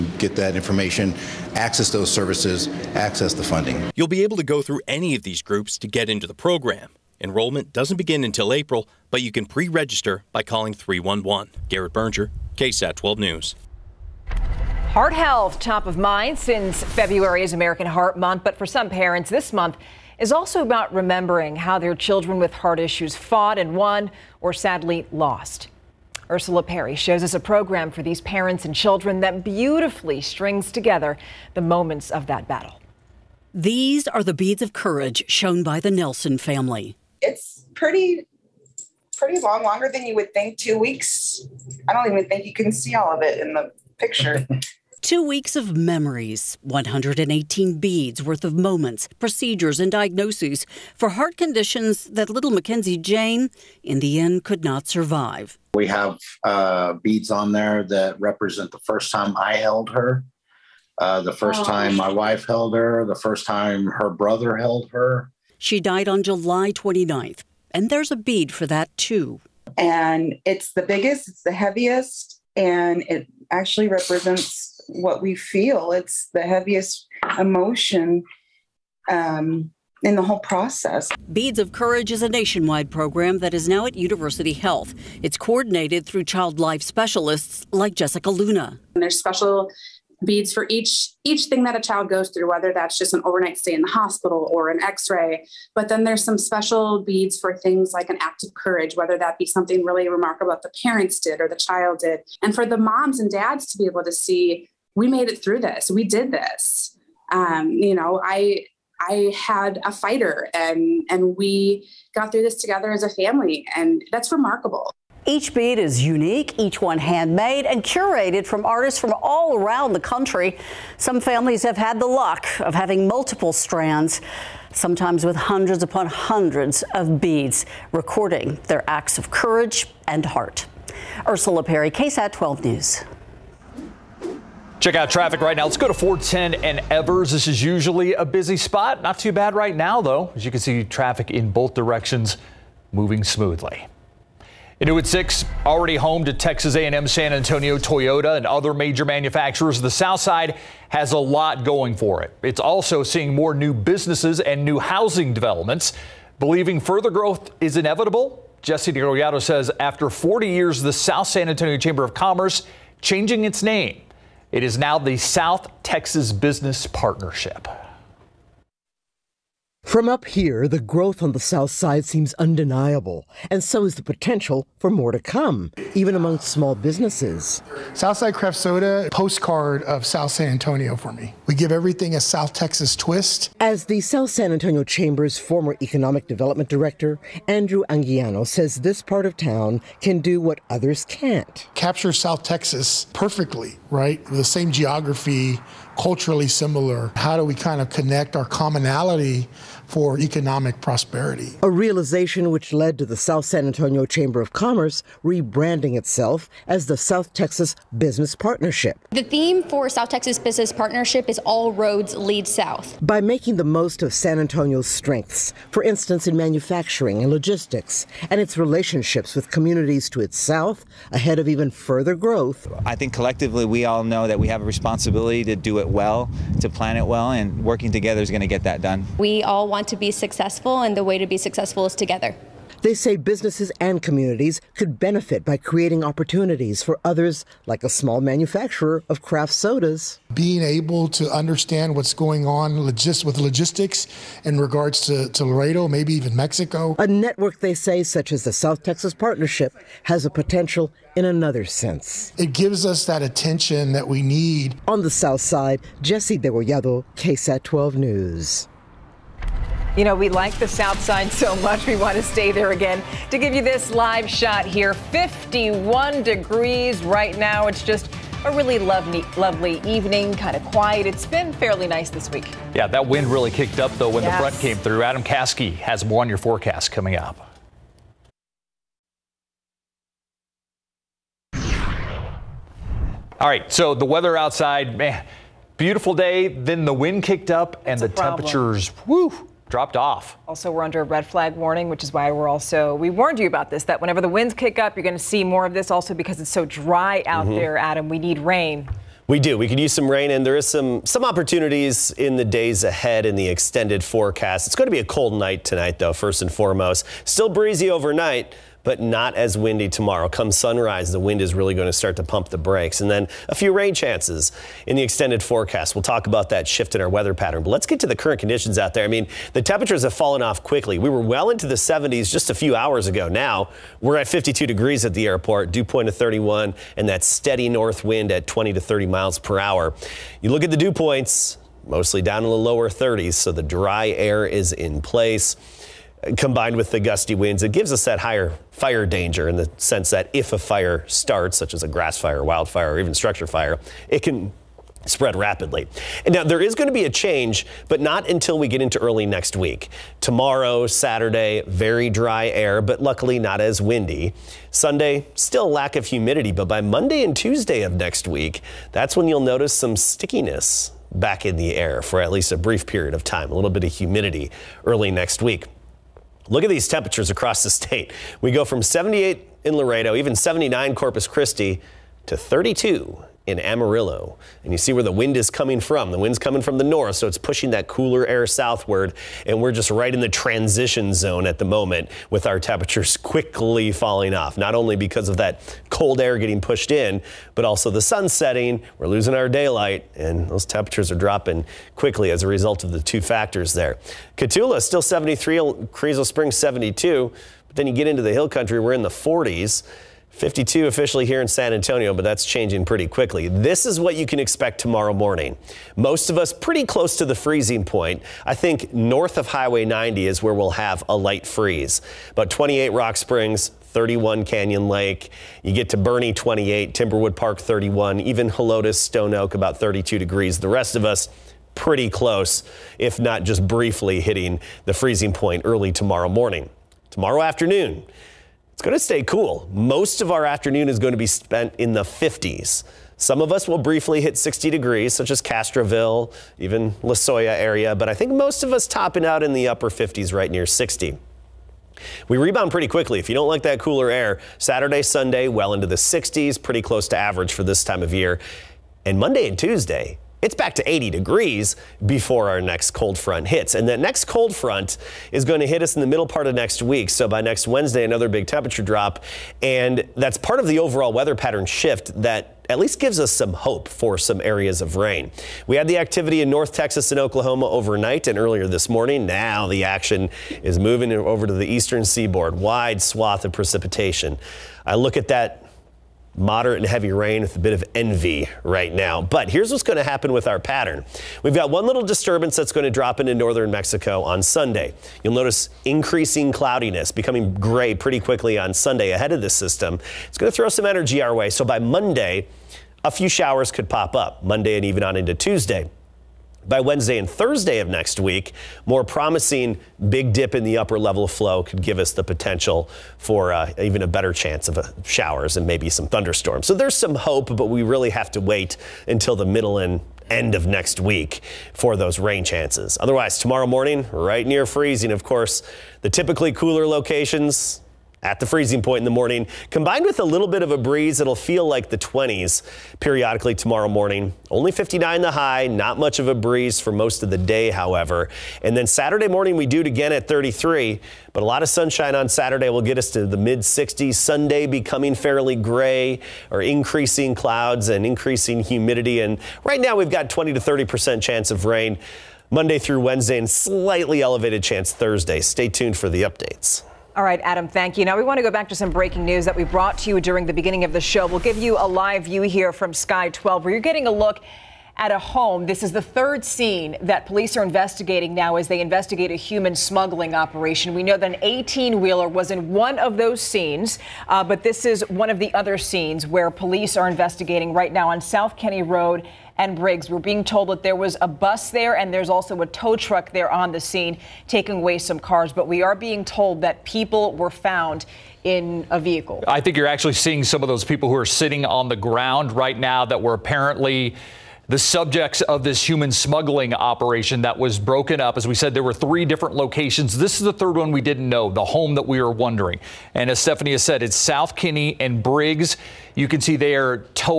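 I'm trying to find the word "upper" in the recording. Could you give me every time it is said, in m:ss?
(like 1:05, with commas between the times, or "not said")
7:19, 8:20.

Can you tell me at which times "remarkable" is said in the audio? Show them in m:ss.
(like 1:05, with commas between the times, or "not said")
1:40, 1:54.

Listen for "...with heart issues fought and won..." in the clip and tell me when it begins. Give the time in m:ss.
0:22.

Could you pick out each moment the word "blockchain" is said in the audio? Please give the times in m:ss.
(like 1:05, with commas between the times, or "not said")
not said.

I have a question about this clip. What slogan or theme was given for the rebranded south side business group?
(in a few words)
All roads lead south.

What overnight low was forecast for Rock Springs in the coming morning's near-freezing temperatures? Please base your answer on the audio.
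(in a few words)
28.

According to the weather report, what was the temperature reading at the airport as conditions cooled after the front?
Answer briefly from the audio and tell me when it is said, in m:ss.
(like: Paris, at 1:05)
52 degrees, at 5:24.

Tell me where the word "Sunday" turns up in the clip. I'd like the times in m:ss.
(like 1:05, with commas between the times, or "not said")
5:54, 7:25, 8:04, 8:08, 8:54.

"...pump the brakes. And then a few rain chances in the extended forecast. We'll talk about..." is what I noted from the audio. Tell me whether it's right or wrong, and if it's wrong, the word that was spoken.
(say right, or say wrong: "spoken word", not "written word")
right.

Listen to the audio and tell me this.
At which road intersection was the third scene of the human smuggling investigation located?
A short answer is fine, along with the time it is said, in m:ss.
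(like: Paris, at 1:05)
South Kenny Road and Briggs, at 9:28.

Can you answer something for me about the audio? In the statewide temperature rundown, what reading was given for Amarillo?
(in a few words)
32.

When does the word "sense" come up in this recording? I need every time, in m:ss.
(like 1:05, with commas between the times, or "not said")
4:11, 5:39.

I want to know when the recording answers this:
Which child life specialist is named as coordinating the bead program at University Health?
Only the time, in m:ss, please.
1:27.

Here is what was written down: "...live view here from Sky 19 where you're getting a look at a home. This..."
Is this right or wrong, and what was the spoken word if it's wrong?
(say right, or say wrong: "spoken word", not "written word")
wrong: "12", not "19".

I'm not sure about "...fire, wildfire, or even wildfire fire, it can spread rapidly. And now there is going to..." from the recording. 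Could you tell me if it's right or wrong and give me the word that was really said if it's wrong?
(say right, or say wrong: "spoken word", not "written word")
wrong: "structure", not "wildfire".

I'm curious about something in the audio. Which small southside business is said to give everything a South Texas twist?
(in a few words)
Southside Craft Soda.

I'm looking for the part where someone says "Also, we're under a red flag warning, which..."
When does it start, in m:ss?
4:50.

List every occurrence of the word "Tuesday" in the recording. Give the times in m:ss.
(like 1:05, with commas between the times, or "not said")
5:57, 7:29, 8:15.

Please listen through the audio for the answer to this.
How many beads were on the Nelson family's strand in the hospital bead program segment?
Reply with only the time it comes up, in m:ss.
0:46.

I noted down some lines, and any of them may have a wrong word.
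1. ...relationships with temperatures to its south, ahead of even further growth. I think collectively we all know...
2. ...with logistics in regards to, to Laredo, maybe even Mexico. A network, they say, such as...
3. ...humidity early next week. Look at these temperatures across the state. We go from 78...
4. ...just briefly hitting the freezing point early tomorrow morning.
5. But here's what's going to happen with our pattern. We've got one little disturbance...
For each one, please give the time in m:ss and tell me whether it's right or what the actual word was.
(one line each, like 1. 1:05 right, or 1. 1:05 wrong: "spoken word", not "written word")
1. 3:38 wrong: "communities", not "temperatures"
2. 4:03 right
3. 6:03 right
4. 7:03 right
5. 7:59 right.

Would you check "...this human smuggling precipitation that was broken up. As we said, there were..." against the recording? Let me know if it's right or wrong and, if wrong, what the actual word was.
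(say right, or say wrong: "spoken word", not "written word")
wrong: "operation", not "precipitation".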